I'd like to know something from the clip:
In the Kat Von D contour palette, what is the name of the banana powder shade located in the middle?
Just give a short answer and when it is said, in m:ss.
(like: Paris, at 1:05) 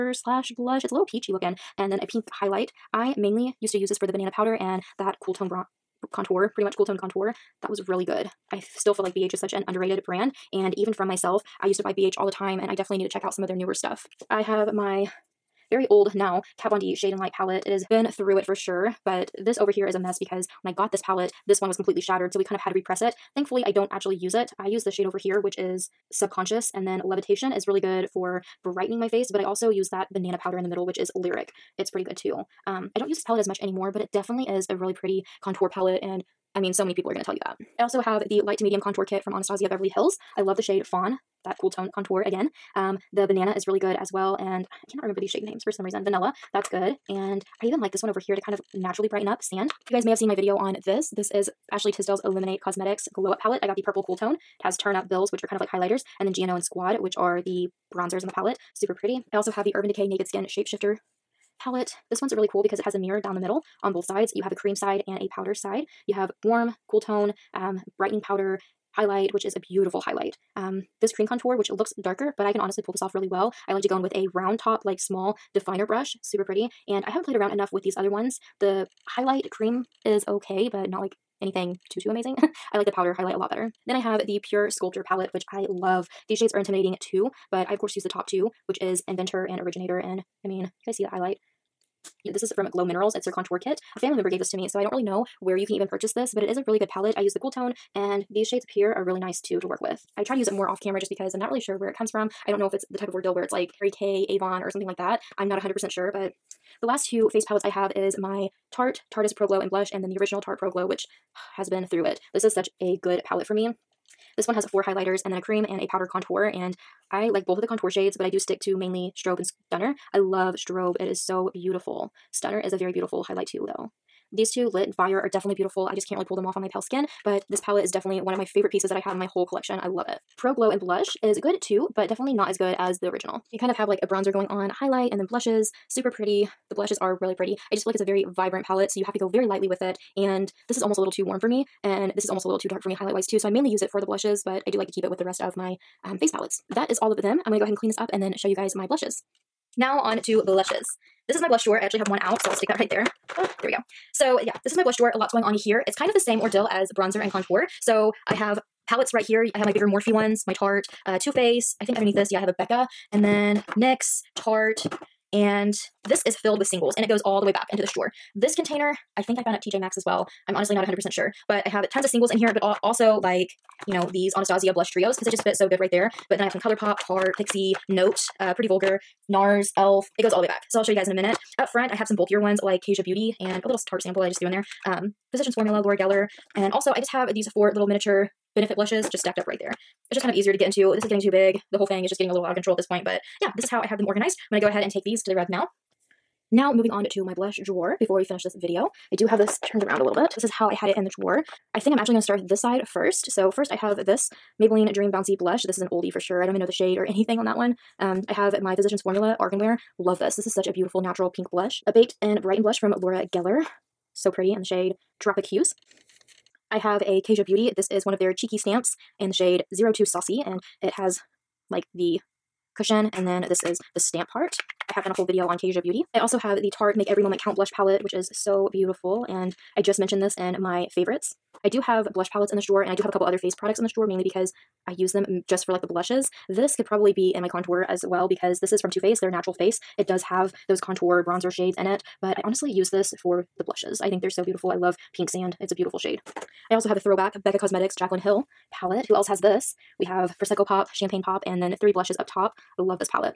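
Lyric, at 0:31.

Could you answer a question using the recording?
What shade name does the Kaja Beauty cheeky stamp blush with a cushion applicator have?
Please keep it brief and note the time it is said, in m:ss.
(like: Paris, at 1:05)
02 Saucy, at 3:39.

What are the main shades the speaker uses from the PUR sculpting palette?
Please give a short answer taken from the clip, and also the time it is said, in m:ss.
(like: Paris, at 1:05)
Inventor and Originator, at 1:29.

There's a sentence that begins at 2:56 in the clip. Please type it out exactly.
But then I have some ColourPop, Tarte, Pixi, Note, uh, Pretty Vulgar, NARS, e.l.f.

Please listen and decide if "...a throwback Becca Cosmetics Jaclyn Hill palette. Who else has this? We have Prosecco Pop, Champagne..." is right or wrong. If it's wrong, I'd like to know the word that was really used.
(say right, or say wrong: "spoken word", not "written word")
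right.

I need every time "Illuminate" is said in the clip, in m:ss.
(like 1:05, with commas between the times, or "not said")
0:52.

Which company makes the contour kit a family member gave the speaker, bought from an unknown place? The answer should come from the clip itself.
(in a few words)
Glow Minerals.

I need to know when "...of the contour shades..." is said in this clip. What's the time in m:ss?
1:57.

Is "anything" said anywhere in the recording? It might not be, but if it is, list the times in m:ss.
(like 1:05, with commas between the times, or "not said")
1:21, 3:27.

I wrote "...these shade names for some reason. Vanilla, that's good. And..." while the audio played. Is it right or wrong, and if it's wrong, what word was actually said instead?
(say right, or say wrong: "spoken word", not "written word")
right.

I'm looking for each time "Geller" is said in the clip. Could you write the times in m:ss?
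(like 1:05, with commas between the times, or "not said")
3:05, 3:33.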